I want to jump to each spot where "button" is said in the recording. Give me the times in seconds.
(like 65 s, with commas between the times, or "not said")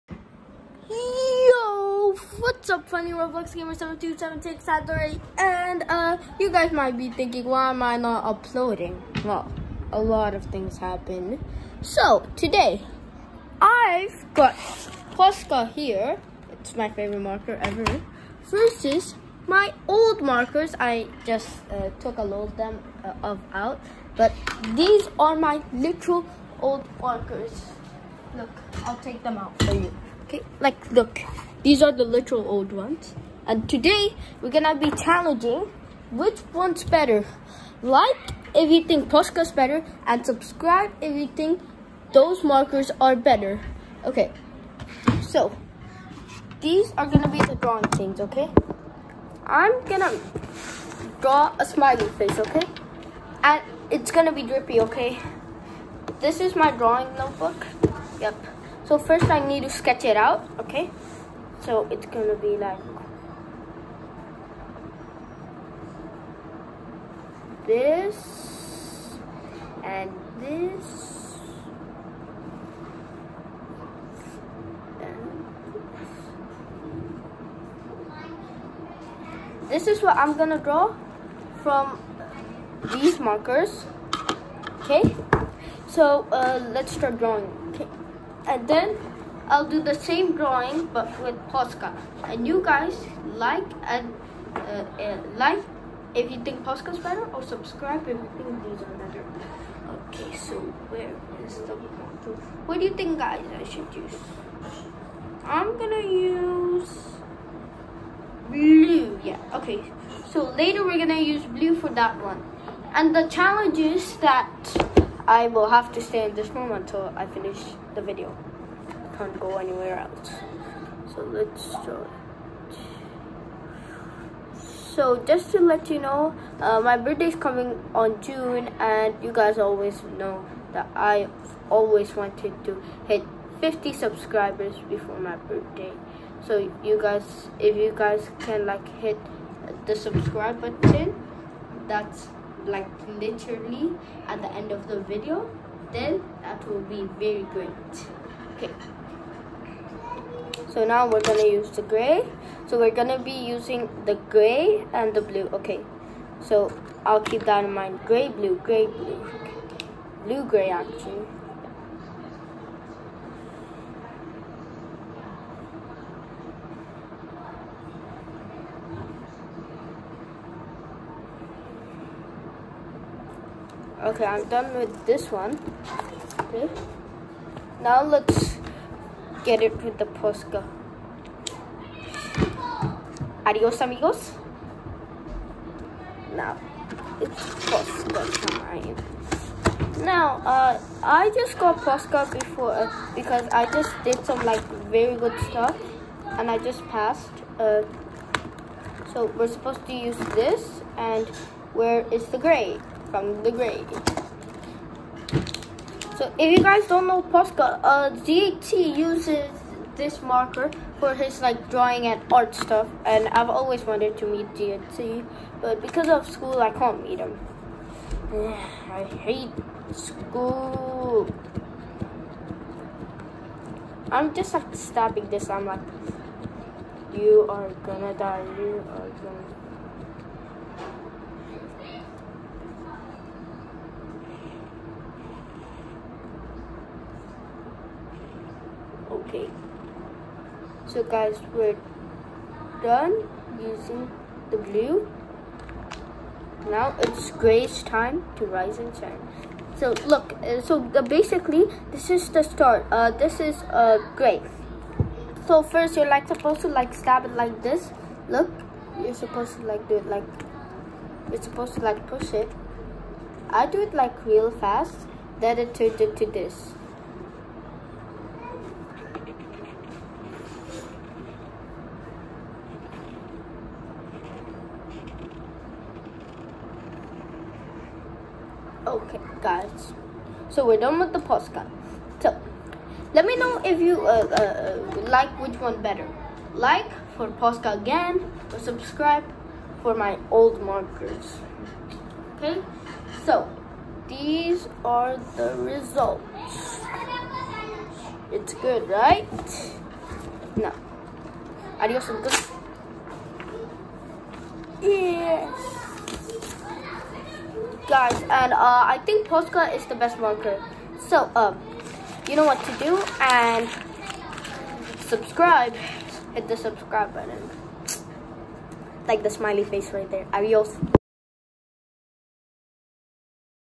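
140 s, 317 s.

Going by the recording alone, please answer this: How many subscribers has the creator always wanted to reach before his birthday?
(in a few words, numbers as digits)
50.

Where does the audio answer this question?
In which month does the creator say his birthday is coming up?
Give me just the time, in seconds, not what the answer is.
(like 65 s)
128 s.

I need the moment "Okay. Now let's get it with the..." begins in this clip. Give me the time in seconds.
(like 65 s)
176 s.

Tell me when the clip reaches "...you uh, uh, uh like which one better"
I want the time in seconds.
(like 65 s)
283 s.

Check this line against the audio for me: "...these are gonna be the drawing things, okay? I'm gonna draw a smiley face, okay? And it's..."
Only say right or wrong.
right.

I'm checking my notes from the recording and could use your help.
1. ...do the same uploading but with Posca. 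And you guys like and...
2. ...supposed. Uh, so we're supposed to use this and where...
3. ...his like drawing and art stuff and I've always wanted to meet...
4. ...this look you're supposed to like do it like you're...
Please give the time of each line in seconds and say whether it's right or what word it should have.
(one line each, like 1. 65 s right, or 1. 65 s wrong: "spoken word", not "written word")
1. 89 s wrong: "drawing", not "uploading"
2. 196 s wrong: "passed", not "supposed"
3. 211 s right
4. 257 s right.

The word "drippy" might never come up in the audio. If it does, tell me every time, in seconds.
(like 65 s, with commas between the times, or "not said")
54 s.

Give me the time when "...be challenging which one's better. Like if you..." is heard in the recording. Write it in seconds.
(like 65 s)
34 s.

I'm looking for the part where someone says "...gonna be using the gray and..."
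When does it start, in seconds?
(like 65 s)
152 s.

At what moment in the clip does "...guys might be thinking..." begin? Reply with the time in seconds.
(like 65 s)
6 s.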